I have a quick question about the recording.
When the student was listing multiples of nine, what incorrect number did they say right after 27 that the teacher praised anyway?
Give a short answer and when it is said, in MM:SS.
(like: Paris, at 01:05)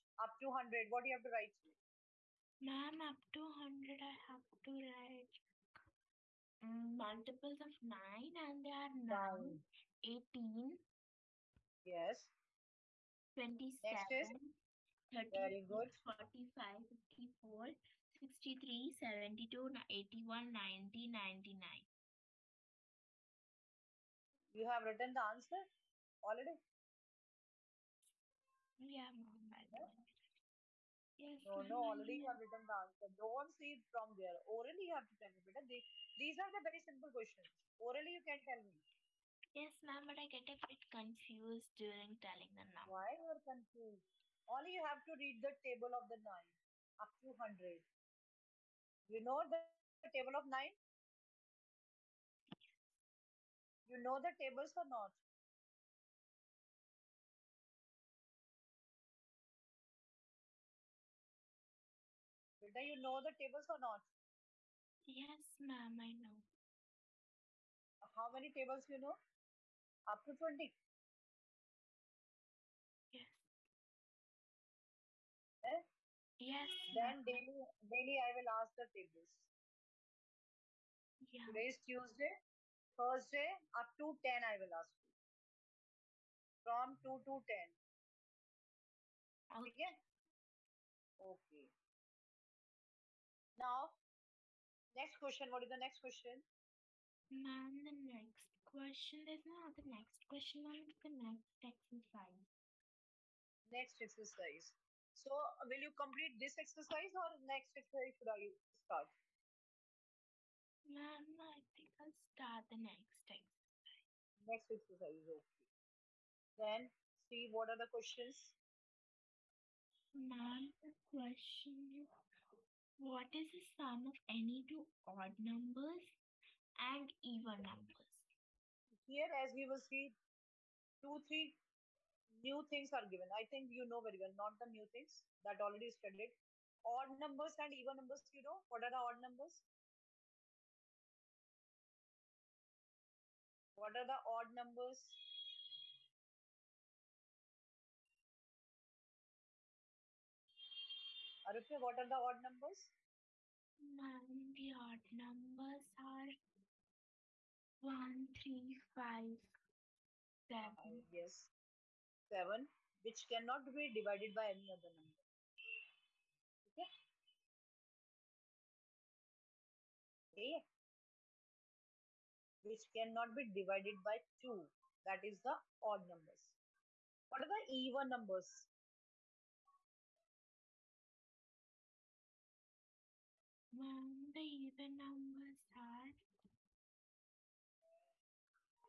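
30, at 00:15.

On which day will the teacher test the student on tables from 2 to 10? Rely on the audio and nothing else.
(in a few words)
Thursday.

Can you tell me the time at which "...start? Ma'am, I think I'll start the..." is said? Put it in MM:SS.
01:48.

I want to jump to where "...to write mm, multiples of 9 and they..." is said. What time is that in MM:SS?
00:04.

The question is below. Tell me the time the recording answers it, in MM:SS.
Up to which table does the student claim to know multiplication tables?
01:10.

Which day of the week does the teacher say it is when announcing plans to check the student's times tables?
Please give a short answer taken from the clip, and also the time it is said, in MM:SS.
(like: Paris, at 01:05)
Tuesday, at 01:21.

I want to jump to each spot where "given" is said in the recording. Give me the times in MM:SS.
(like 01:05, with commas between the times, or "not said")
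02:13.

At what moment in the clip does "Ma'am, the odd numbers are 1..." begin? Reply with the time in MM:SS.
02:33.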